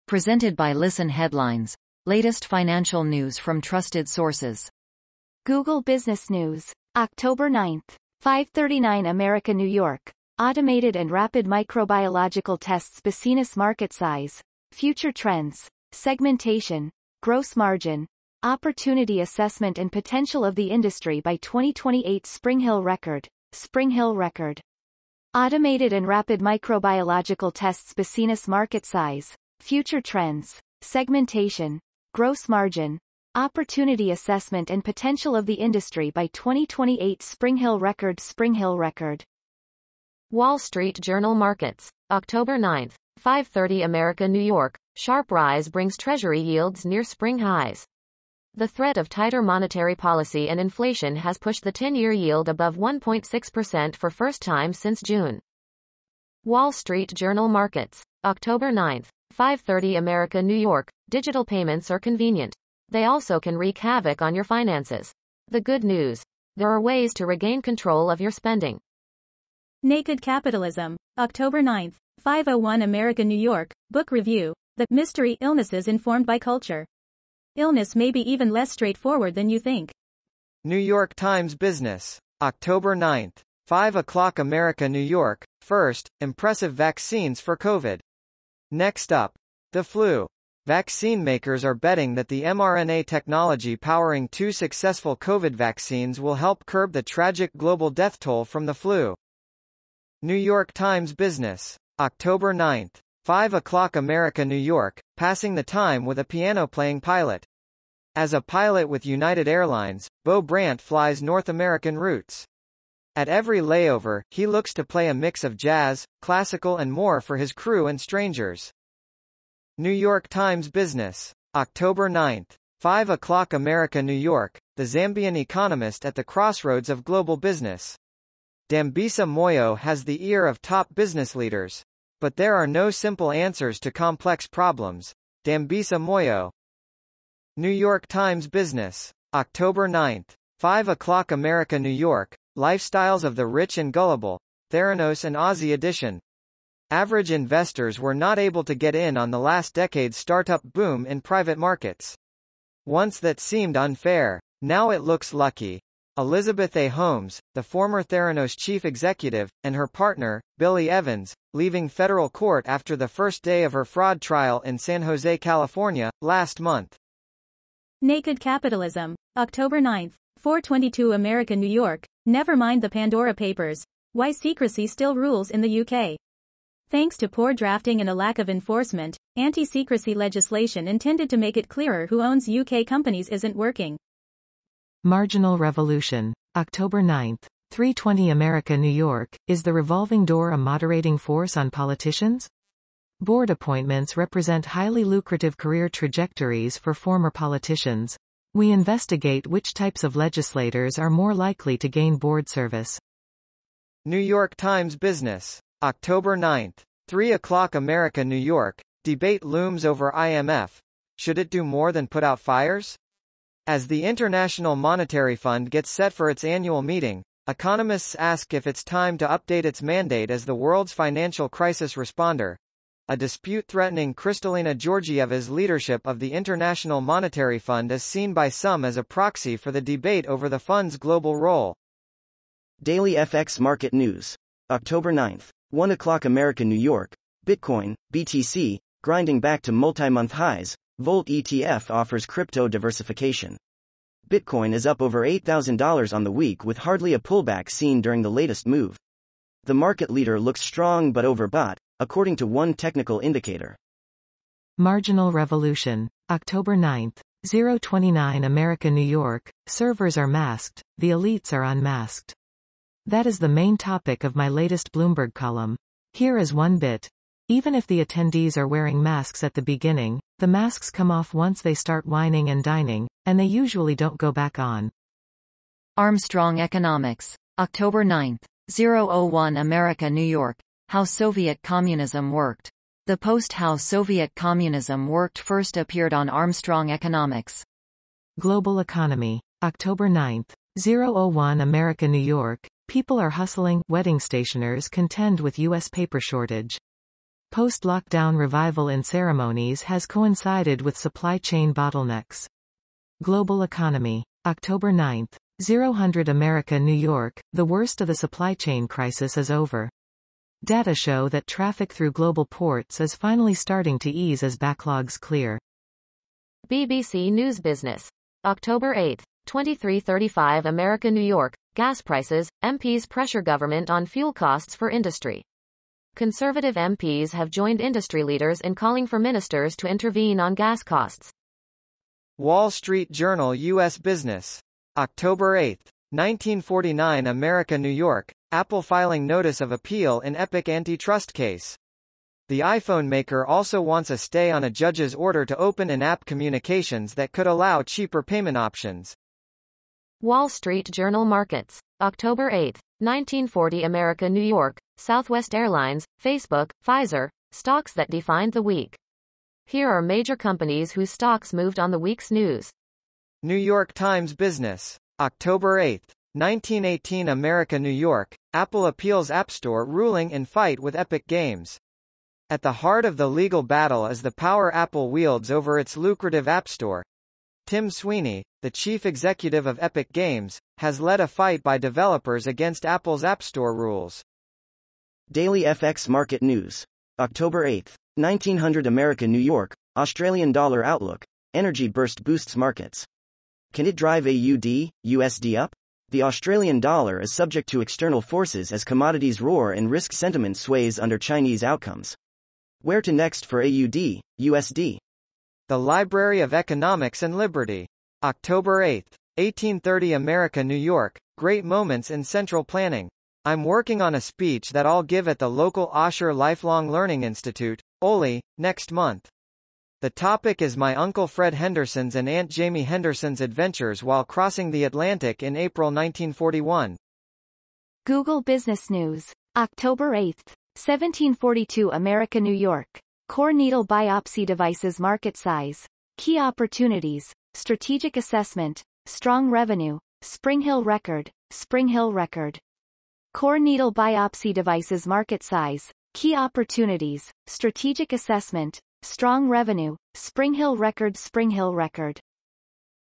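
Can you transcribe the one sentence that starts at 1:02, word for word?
They also can wreak havoc on your finances.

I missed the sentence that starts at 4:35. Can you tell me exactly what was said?
Armstrong Economics, October 9, 001 America, New York, how Soviet Communism Worked.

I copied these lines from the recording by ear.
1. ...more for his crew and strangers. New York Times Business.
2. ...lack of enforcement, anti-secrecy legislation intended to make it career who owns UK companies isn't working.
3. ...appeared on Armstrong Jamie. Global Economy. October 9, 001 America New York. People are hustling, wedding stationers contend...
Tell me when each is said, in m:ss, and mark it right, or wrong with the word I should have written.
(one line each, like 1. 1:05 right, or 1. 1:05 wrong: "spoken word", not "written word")
1. 1:56 right
2. 2:58 wrong: "clearer", not "career"
3. 4:45 wrong: "Economics", not "Jamie".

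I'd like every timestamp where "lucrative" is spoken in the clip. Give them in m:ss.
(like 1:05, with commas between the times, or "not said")
3:15, 6:15.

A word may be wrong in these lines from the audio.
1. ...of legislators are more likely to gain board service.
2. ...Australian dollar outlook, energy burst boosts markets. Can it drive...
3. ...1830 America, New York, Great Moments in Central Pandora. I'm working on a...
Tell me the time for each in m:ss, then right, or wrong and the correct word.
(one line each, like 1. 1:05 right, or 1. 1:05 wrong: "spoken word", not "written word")
1. 3:20 right
2. 6:29 right
3. 6:49 wrong: "Planning", not "Pandora".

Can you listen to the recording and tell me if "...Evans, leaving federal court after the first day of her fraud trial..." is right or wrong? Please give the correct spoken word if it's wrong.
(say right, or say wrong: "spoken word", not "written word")
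right.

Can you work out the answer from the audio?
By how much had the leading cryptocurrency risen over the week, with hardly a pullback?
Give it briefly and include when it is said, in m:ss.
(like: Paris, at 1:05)
$8,000, at 4:05.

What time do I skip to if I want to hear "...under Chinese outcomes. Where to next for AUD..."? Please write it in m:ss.
6:40.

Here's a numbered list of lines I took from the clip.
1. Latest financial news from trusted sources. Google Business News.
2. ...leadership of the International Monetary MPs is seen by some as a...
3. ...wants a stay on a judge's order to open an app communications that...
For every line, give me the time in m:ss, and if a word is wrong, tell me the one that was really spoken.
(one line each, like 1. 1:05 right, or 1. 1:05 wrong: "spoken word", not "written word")
1. 0:02 right
2. 3:45 wrong: "Fund", not "MPs"
3. 5:43 right.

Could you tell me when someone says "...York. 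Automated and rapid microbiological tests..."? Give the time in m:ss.
0:09.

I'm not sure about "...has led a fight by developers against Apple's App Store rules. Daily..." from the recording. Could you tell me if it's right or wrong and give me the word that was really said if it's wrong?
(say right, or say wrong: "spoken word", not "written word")
right.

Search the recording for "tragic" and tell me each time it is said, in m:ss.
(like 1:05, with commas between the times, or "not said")
1:37.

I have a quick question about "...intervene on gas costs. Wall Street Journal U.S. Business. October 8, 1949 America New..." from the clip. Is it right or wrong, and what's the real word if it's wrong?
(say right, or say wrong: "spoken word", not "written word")
right.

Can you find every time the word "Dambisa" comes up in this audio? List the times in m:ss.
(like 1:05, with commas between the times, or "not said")
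2:08, 2:15.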